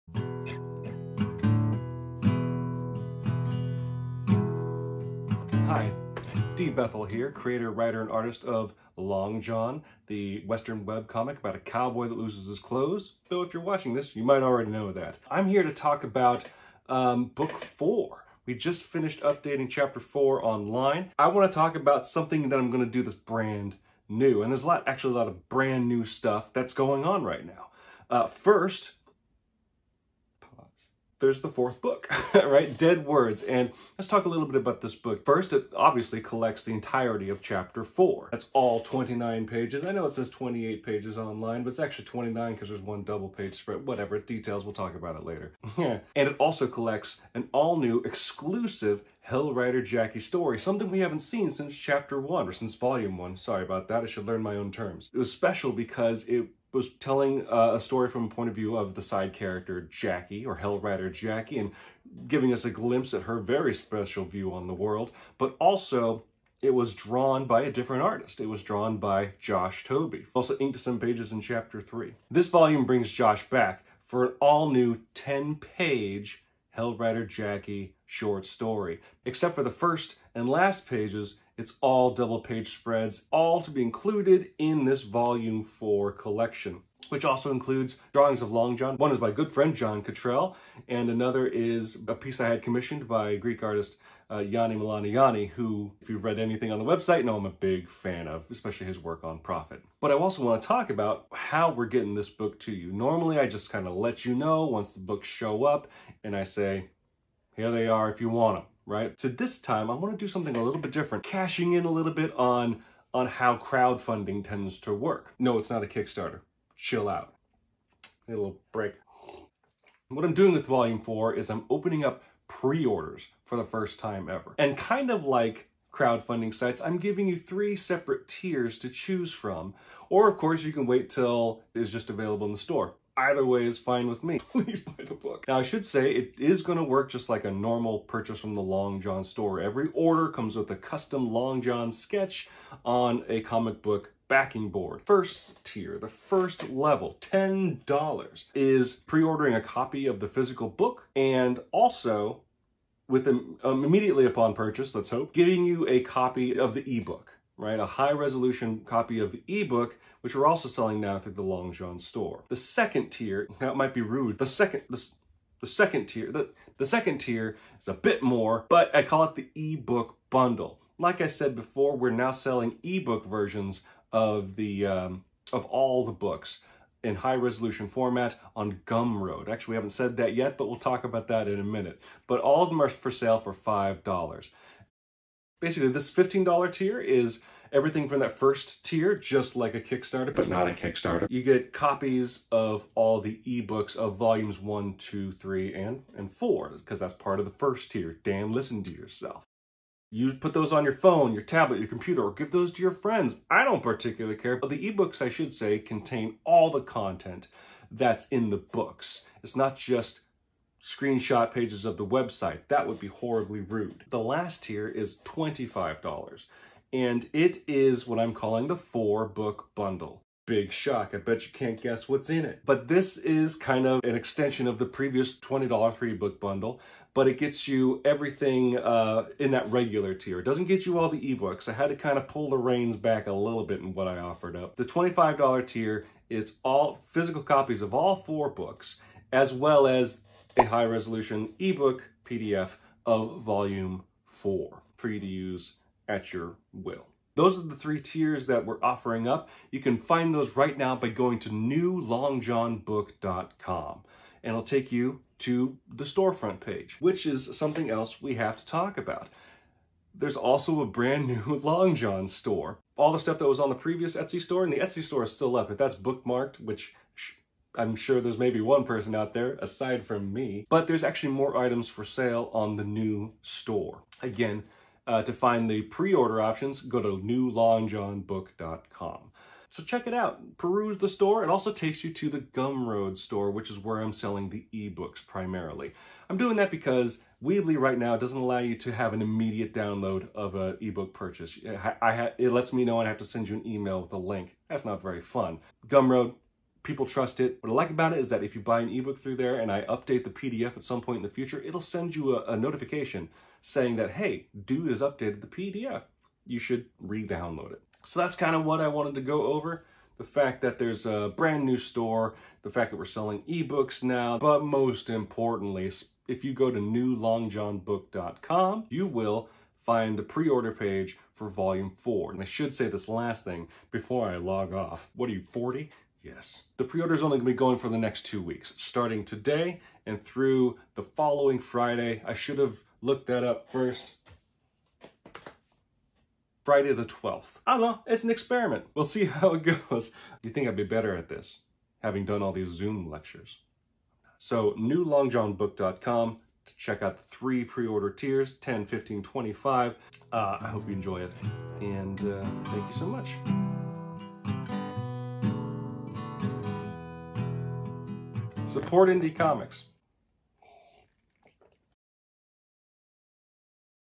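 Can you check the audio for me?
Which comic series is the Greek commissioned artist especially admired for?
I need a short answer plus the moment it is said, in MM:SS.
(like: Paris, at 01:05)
Prophet, at 01:39.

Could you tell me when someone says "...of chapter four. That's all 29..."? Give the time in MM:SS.
00:37.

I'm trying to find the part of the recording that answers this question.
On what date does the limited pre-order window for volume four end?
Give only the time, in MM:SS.
05:36.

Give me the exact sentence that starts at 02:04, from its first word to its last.
And kind of like crowdfunding sites, I'm giving you three separate tiers to choose from.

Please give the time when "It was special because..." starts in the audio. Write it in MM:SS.
00:55.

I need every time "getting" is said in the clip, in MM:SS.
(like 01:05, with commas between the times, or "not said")
01:41, 02:35.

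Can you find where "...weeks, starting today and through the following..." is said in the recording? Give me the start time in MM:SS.
05:28.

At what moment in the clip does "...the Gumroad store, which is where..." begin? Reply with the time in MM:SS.
04:42.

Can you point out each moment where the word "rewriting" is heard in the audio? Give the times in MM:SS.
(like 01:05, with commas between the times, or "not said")
not said.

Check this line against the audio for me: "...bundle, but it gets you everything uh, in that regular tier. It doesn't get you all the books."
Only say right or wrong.
wrong.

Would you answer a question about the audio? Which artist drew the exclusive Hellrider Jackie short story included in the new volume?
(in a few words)
Josh Tobey.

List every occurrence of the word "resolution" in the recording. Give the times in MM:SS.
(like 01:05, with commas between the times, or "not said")
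02:38, 02:57, 04:00.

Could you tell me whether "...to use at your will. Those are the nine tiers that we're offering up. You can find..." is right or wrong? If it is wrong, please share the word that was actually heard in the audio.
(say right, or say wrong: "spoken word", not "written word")
wrong: "three", not "nine".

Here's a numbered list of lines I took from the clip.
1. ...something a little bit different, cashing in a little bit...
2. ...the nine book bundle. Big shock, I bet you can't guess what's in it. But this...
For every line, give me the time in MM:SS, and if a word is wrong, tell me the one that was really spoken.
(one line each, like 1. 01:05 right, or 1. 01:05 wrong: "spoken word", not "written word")
1. 01:50 right
2. 03:38 wrong: "four", not "nine".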